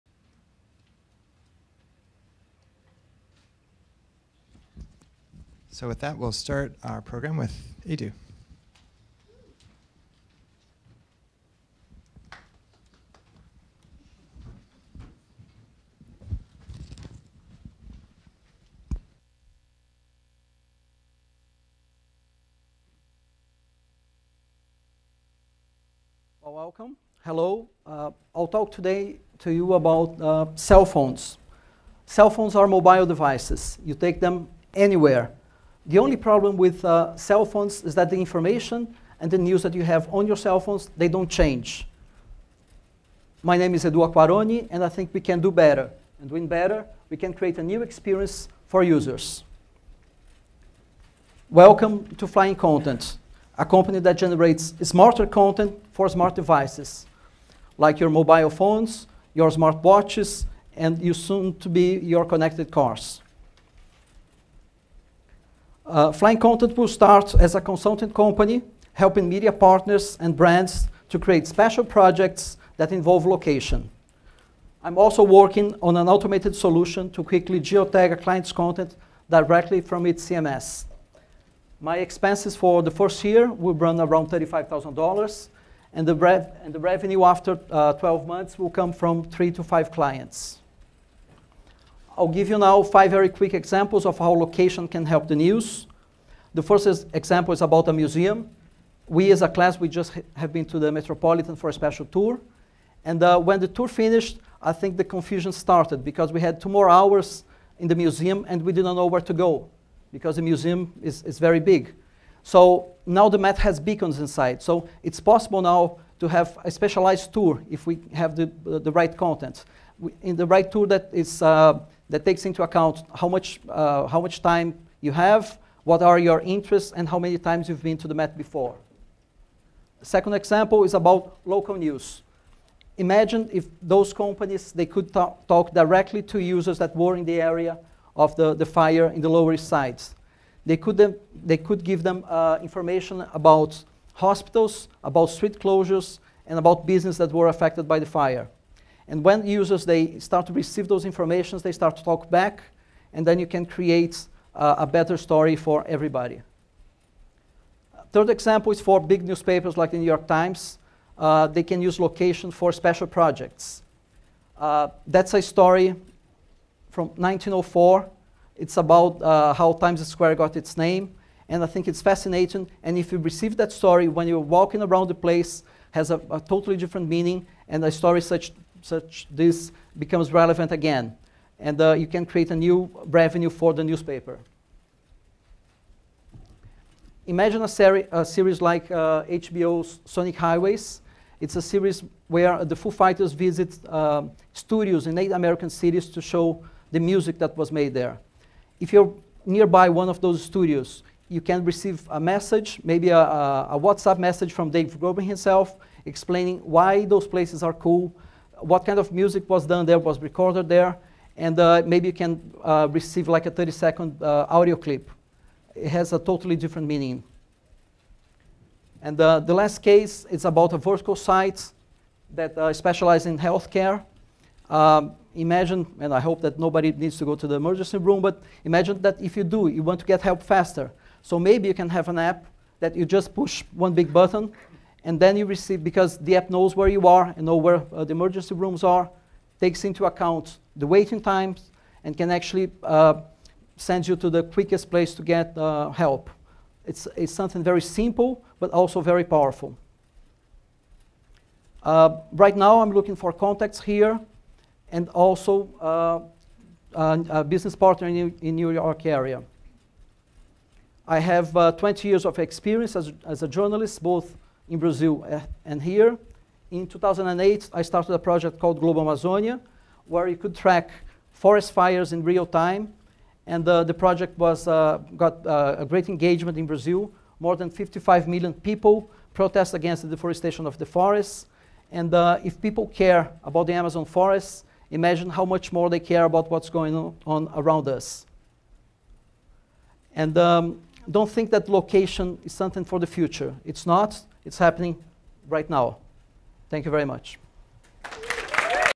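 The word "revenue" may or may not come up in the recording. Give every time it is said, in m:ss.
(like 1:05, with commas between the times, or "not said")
1:26, 3:03.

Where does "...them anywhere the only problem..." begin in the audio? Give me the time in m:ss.
0:34.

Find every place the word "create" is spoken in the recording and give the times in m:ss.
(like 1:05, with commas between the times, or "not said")
0:47, 1:11, 2:33, 3:02.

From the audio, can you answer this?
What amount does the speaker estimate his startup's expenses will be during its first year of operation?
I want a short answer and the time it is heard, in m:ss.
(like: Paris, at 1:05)
$35,000, at 1:24.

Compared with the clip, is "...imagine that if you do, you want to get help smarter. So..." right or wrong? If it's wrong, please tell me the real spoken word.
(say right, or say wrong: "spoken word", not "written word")
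wrong: "faster", not "smarter".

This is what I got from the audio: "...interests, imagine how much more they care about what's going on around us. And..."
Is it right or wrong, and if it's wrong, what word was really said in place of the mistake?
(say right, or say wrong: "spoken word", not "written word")
wrong: "forests", not "interests".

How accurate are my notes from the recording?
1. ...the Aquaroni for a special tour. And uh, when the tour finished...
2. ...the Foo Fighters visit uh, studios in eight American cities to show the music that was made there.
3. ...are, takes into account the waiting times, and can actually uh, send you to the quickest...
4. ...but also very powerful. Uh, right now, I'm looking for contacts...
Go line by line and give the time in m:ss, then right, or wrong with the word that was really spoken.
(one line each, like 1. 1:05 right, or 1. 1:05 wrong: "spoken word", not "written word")
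1. 1:40 wrong: "Metropolitan", not "Aquaroni"
2. 3:12 right
3. 3:58 right
4. 4:08 right.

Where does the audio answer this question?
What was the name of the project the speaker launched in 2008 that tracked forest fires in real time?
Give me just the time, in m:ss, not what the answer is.
4:28.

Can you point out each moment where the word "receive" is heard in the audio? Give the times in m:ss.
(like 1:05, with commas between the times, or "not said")
2:30, 2:53, 3:21, 3:32, 3:55.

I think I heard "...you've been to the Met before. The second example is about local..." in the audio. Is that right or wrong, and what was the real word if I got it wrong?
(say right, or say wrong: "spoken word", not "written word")
right.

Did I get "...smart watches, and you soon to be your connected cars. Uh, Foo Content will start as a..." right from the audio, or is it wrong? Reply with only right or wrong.
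wrong.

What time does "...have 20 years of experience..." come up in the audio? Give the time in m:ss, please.
4:21.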